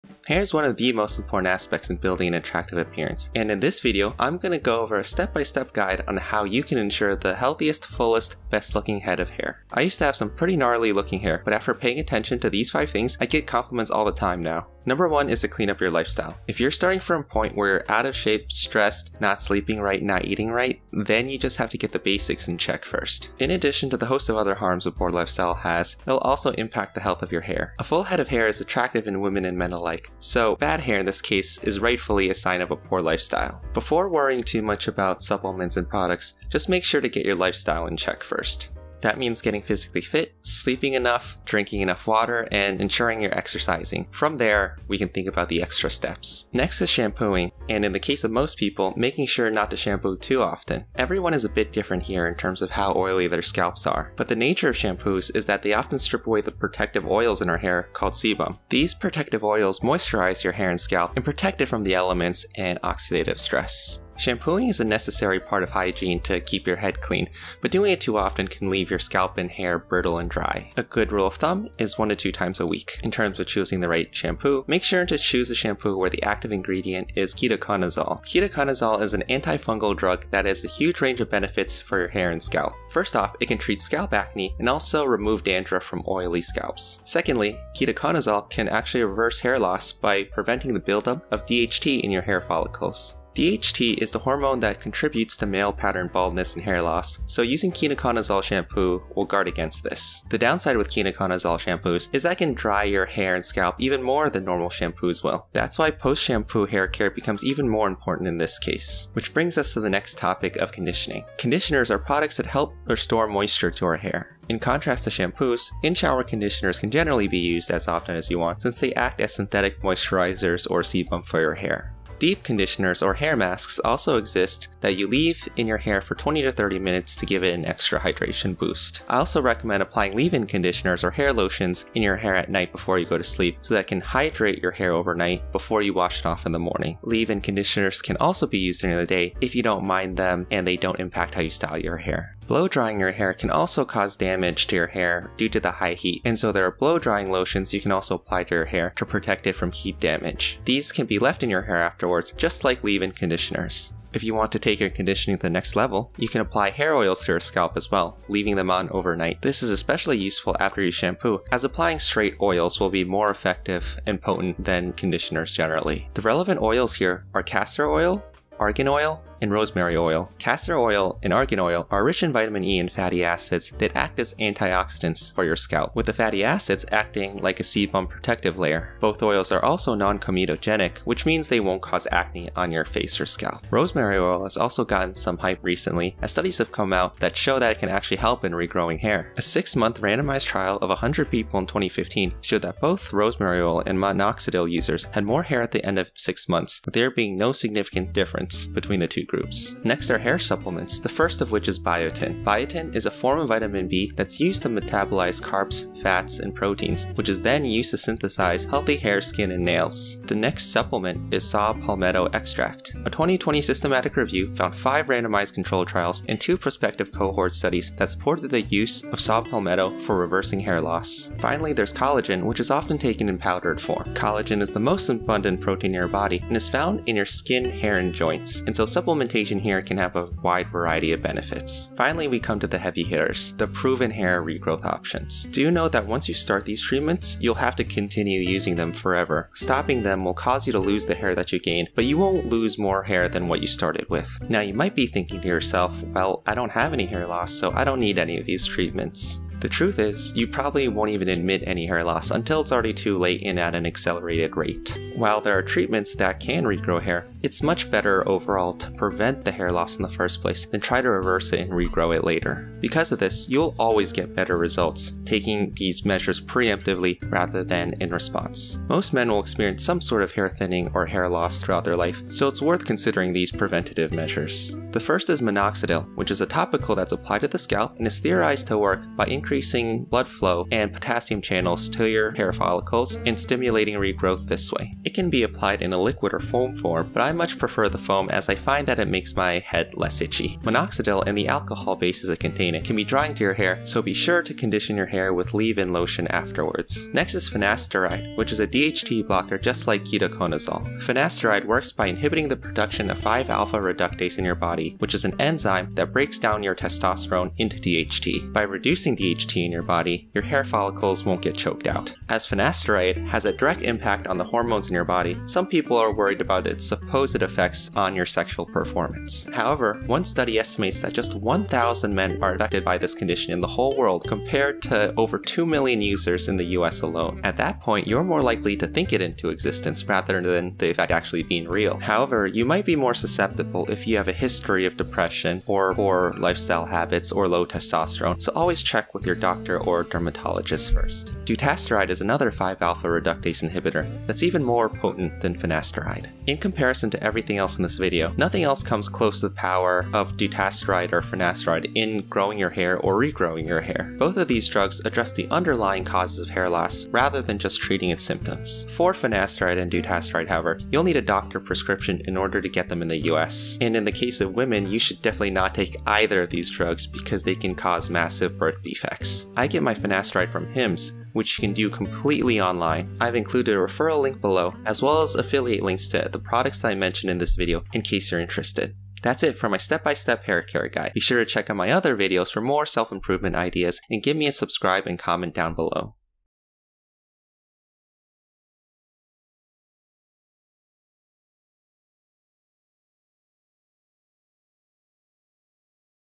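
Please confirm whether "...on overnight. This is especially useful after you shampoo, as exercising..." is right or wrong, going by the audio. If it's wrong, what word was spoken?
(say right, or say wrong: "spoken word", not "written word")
wrong: "applying", not "exercising".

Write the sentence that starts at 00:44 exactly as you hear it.
From there, we can think about the extra steps.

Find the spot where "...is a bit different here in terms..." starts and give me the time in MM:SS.
00:51.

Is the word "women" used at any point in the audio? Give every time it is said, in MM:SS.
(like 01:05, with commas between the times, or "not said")
00:29, 06:04.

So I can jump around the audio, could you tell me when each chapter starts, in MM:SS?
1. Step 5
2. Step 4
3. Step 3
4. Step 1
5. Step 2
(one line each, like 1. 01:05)
1. 03:52
2. 03:19
3. 01:49
4. 00:24
5. 00:46.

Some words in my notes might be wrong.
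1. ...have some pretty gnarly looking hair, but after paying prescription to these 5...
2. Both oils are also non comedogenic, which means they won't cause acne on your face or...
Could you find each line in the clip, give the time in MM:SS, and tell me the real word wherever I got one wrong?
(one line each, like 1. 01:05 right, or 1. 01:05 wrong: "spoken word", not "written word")
1. 00:10 wrong: "attention", not "prescription"
2. 02:59 right.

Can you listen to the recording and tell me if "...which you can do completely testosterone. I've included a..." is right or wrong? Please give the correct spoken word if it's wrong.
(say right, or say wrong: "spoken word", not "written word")
wrong: "online", not "testosterone".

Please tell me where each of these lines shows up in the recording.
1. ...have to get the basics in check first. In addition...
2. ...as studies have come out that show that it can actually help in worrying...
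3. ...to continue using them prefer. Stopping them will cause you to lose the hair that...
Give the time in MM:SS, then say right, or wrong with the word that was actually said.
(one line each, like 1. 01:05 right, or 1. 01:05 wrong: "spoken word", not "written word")
1. 00:21 right
2. 03:06 wrong: "regrowing", not "worrying"
3. 03:57 wrong: "forever", not "prefer".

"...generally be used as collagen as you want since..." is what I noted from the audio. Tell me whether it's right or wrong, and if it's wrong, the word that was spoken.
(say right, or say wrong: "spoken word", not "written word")
wrong: "often", not "collagen".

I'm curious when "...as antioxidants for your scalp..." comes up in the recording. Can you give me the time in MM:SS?
02:54.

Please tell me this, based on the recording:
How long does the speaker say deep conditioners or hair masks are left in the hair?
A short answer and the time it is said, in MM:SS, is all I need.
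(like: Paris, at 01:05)
20 to 30 minutes, at 02:06.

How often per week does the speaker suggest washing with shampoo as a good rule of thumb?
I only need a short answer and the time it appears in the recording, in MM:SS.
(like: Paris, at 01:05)
1 to 2 times, at 01:11.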